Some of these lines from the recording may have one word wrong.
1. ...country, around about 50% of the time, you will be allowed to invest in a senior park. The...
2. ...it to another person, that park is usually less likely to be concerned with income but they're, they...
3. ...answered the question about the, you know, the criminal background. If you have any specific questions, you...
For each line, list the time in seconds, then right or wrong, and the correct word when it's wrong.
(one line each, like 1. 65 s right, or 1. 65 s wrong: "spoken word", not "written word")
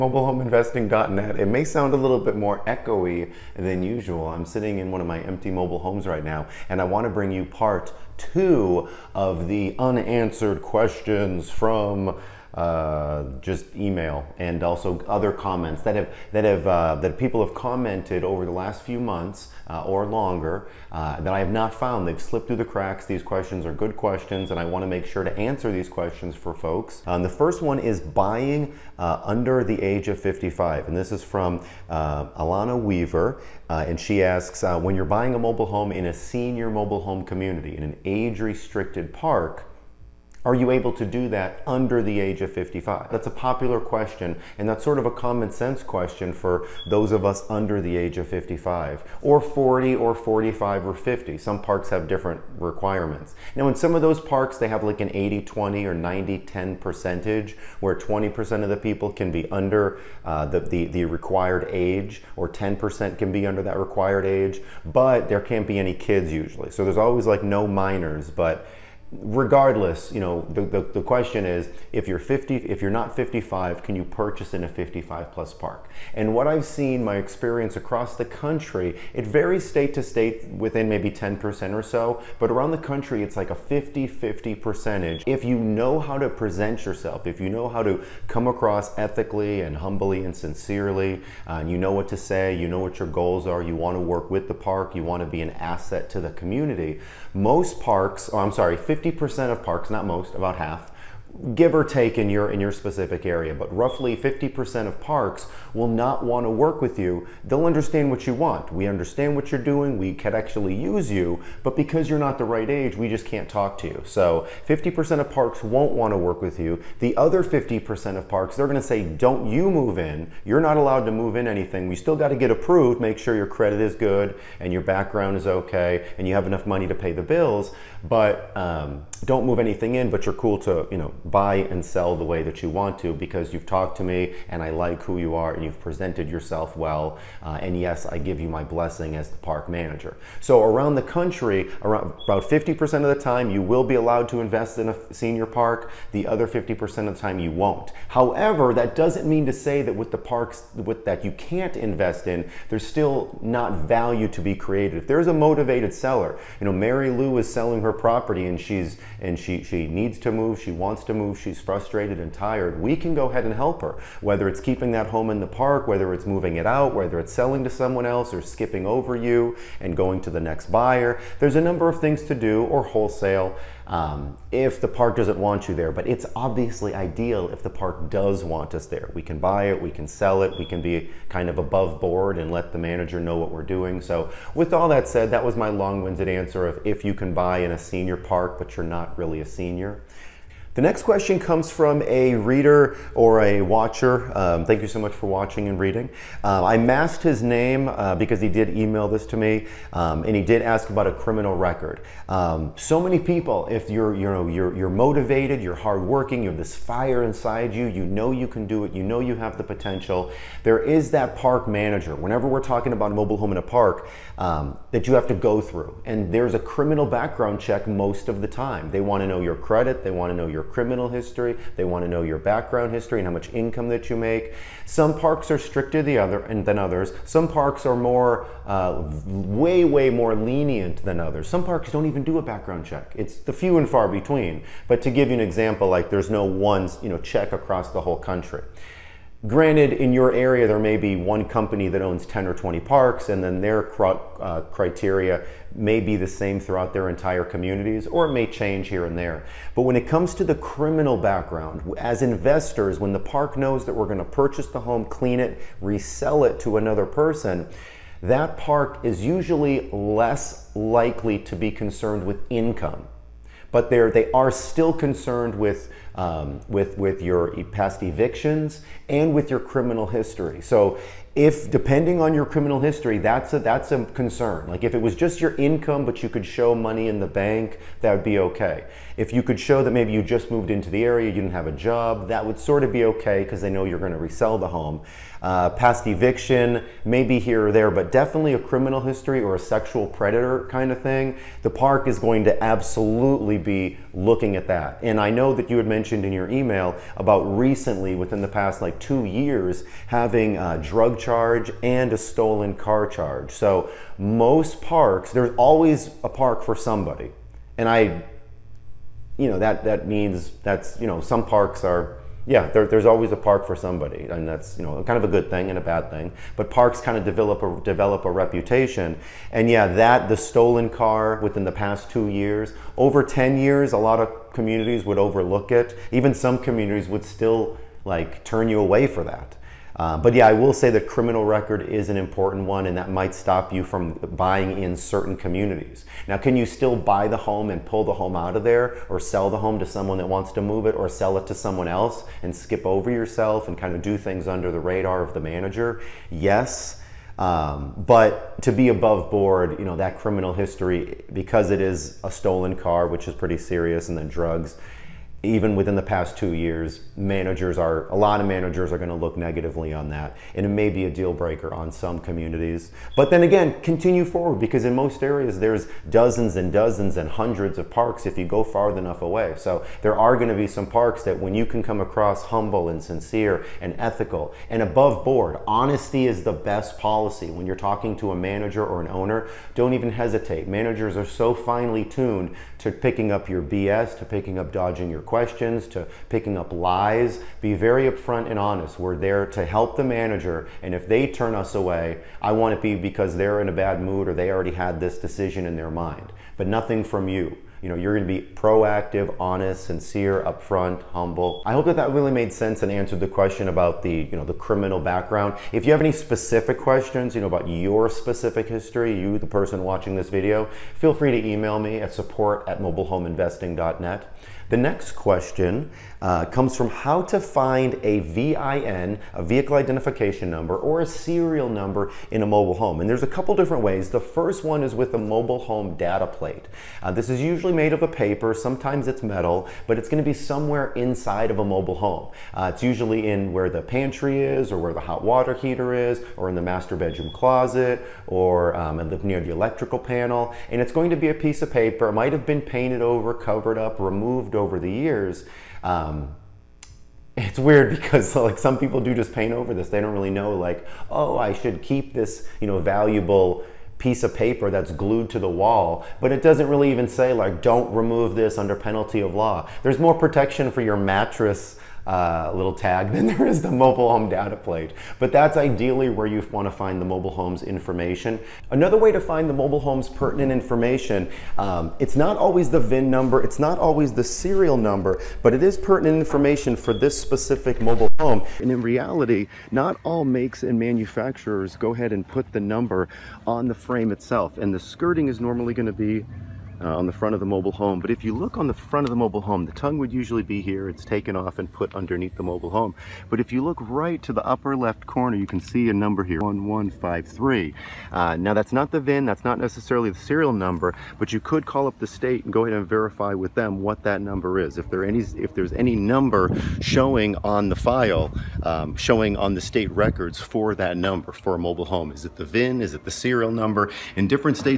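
1. 141 s right
2. 256 s right
3. 402 s right.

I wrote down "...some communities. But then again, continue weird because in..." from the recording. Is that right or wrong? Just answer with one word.
wrong.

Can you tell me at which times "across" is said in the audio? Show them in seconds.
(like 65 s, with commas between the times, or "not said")
77 s, 88 s, 237 s, 372 s.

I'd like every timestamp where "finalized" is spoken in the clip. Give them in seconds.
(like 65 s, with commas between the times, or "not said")
not said.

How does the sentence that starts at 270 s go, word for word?
So if depending on your criminal history, that's a, that's a concern.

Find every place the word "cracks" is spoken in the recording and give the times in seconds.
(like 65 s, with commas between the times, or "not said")
22 s.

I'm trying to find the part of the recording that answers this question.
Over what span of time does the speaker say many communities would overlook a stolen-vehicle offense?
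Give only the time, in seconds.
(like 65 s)
322 s.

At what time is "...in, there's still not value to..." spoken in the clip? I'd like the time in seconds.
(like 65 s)
152 s.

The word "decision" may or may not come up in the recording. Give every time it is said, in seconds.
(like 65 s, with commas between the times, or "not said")
395 s.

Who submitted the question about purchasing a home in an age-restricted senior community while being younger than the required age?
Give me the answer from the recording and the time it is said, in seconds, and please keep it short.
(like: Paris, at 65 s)
Alana Weaver, at 31 s.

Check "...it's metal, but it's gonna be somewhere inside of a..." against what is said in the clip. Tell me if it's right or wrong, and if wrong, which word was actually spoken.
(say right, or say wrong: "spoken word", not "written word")
right.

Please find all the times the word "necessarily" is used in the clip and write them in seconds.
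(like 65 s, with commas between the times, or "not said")
499 s.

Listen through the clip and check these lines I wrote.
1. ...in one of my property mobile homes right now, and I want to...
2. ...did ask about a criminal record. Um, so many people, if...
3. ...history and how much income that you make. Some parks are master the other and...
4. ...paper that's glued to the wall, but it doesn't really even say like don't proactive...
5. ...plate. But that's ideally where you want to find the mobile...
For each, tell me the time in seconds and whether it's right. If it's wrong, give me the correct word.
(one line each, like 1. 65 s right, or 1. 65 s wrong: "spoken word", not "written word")
1. 4 s wrong: "empty", not "property"
2. 200 s right
3. 222 s wrong: "stricter", not "master"
4. 454 s wrong: "remove", not "proactive"
5. 464 s right.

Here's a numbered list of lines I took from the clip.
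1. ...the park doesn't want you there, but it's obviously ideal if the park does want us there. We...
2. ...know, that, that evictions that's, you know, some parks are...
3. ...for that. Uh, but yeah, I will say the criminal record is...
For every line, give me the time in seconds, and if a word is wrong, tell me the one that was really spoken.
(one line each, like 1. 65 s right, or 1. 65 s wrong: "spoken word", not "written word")
1. 174 s right
2. 309 s wrong: "means", not "evictions"
3. 329 s right.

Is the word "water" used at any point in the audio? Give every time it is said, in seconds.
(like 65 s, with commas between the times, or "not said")
435 s.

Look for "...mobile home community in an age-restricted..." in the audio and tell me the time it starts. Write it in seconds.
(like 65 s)
36 s.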